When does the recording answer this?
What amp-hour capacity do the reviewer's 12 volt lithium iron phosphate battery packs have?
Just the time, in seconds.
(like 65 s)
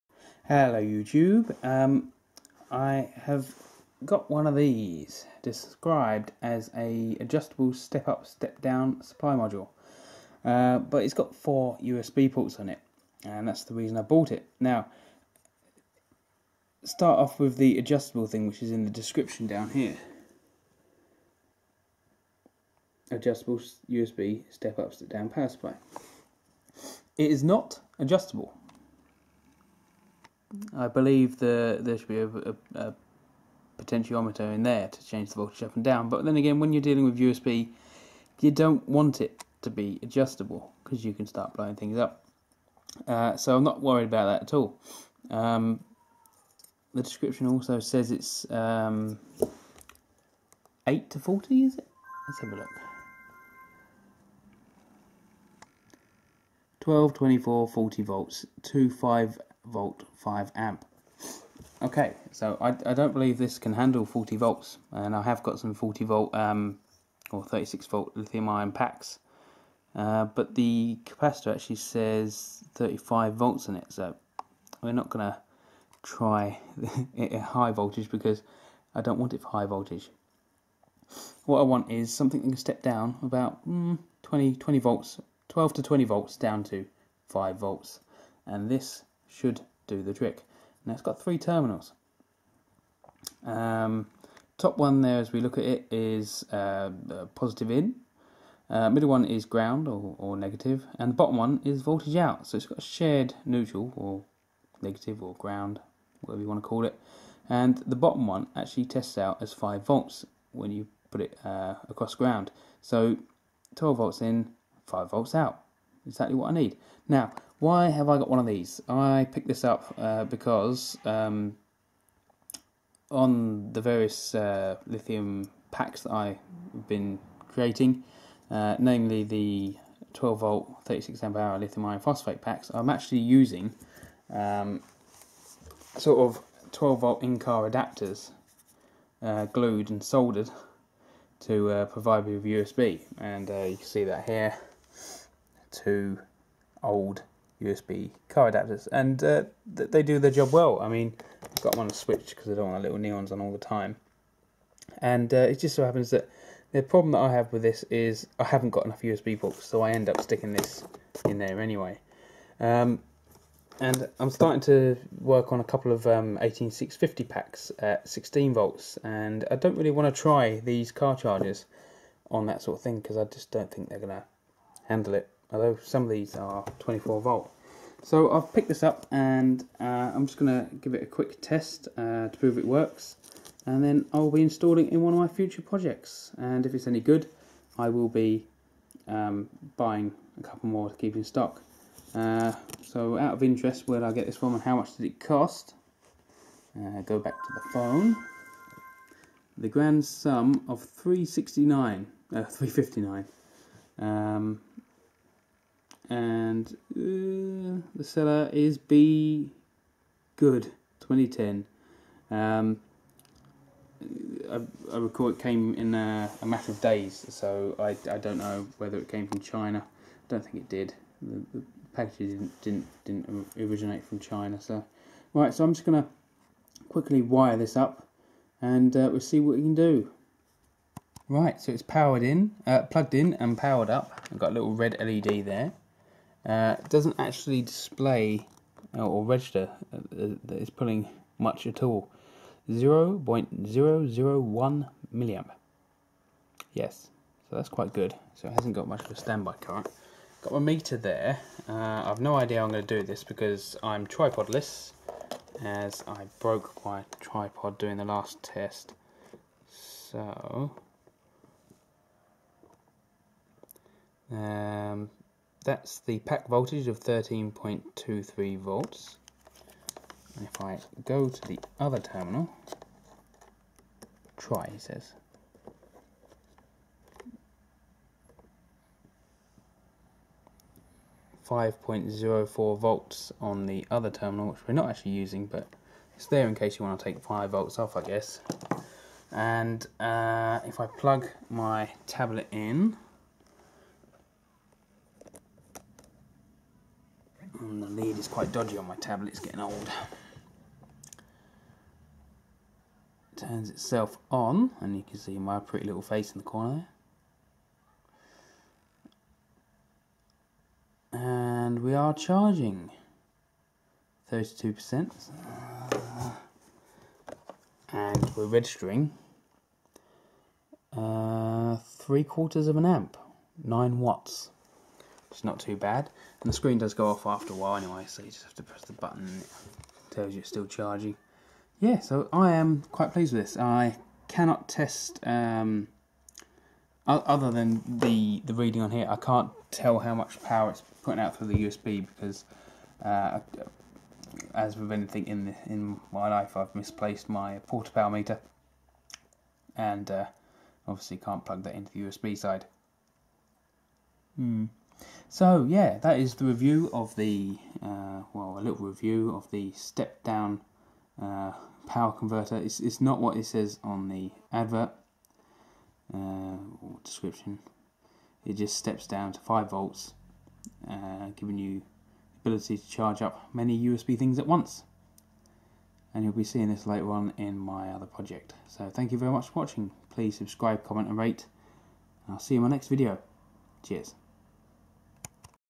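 130 s.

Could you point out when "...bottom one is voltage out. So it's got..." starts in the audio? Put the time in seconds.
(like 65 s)
101 s.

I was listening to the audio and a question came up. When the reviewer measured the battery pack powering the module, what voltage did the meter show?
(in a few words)
13.23 volts.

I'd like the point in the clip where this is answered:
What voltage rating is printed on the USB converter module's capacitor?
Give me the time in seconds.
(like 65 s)
72 s.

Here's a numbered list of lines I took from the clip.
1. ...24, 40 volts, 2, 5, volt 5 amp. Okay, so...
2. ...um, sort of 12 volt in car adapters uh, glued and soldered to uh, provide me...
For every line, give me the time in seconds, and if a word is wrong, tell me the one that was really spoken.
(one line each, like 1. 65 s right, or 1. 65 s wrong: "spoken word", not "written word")
1. 57 s right
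2. 134 s right.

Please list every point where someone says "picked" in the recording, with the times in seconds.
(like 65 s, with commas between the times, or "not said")
119 s, 178 s.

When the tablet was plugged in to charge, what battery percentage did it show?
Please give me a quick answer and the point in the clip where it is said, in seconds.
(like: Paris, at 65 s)
32%, at 314 s.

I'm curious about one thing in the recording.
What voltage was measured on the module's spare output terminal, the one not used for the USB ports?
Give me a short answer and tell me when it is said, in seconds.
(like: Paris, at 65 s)
5.04 volts, at 281 s.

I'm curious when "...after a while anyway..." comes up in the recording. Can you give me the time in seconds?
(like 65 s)
327 s.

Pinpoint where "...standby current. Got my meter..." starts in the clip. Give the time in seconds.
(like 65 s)
249 s.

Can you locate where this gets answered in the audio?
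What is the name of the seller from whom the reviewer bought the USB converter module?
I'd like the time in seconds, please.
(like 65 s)
208 s.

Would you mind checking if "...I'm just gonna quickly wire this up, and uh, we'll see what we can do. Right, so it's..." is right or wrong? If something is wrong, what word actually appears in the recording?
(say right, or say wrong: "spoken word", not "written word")
right.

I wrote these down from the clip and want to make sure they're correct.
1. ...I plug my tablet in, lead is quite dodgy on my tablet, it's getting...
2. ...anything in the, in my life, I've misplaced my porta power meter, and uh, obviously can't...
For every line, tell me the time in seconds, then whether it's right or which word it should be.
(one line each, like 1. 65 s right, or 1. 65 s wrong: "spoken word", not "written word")
1. 290 s right
2. 344 s right.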